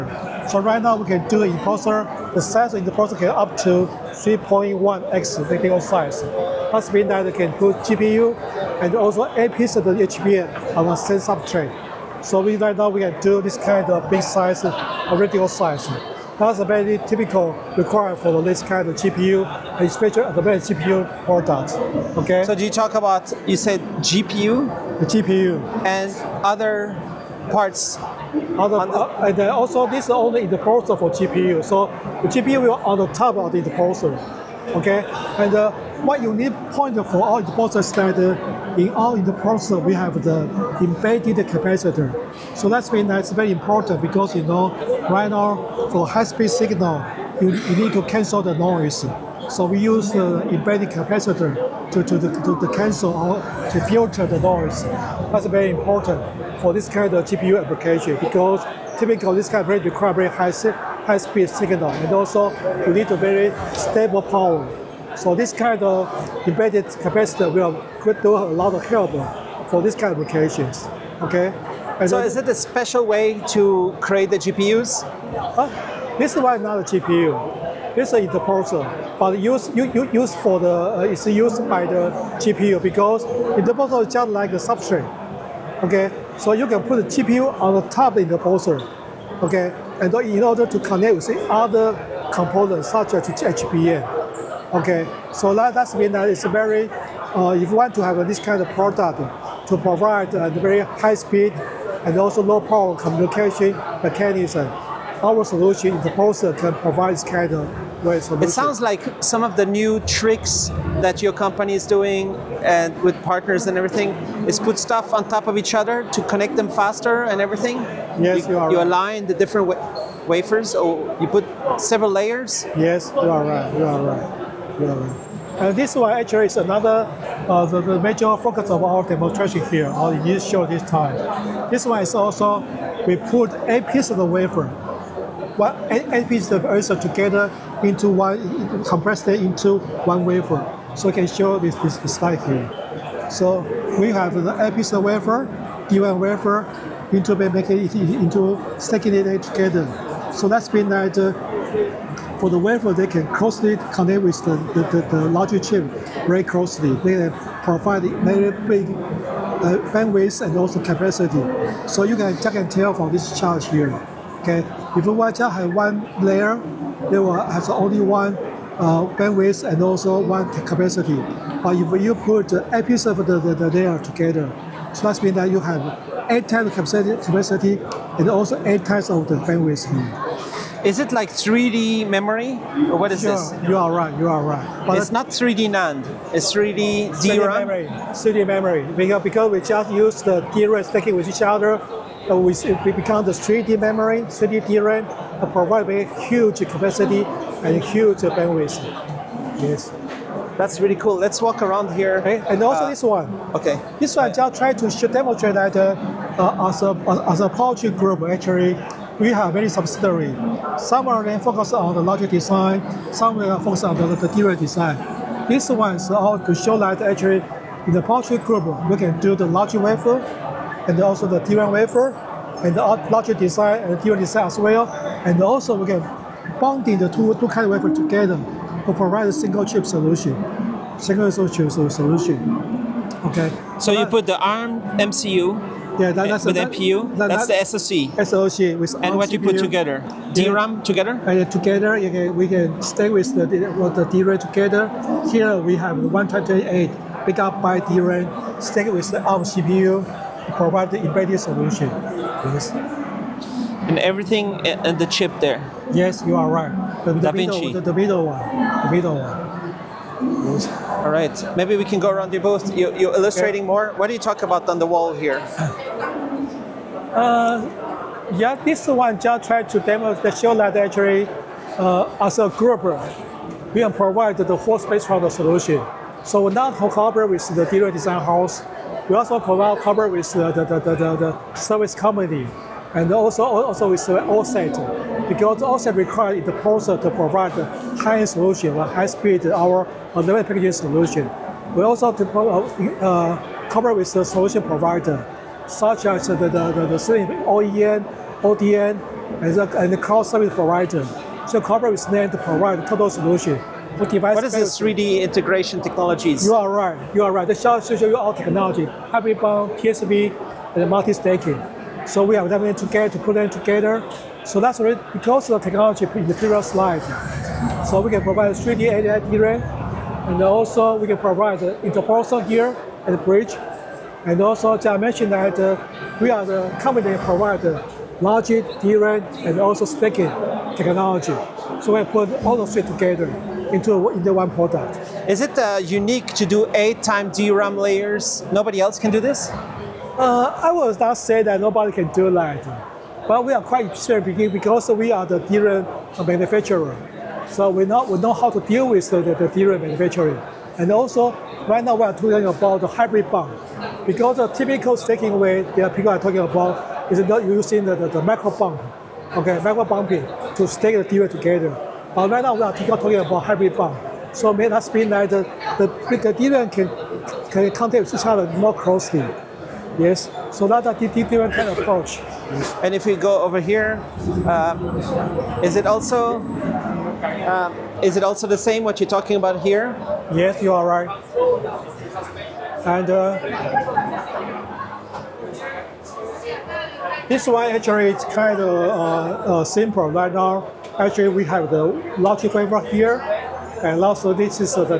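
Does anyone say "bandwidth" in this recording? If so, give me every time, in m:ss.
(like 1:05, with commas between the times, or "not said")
2:39, 2:49, 2:59, 3:18.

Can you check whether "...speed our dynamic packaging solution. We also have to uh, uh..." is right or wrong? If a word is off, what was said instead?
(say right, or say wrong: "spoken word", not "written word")
right.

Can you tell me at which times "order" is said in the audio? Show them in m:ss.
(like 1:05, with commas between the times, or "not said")
1:30.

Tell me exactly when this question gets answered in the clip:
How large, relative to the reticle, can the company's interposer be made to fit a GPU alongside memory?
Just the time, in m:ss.
0:04.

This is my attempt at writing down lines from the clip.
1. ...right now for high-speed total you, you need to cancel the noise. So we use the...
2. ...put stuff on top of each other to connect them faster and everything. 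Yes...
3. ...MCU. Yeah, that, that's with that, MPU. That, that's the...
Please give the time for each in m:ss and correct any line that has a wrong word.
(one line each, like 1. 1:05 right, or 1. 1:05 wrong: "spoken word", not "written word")
1. 0:45 wrong: "signal", not "total"
2. 1:54 right
3. 3:54 right.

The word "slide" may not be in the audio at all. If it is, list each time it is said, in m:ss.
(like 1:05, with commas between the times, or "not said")
2:22, 5:16.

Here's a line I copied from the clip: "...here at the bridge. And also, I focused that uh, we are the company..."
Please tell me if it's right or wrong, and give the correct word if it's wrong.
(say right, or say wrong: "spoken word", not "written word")
wrong: "mentioned", not "focused".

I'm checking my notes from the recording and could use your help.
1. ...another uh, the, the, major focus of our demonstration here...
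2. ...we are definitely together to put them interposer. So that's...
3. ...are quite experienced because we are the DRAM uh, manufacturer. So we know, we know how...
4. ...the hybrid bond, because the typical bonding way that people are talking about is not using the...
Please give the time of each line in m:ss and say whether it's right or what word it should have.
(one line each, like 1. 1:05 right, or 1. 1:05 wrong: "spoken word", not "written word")
1. 2:06 right
2. 5:12 wrong: "together", not "interposer"
3. 5:43 right
4. 5:52 wrong: "staking", not "bonding".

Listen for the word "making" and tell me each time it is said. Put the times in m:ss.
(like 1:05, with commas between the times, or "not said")
2:27.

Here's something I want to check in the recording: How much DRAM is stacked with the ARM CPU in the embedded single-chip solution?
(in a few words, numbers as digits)
128.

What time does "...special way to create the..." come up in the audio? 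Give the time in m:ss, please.
1:12.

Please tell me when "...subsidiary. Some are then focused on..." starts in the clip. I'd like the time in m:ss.
3:29.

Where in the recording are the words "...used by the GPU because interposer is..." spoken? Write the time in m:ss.
1:21.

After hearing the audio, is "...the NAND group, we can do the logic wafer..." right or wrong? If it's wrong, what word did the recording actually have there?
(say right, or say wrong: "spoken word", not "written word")
wrong: "Powerchip", not "NAND".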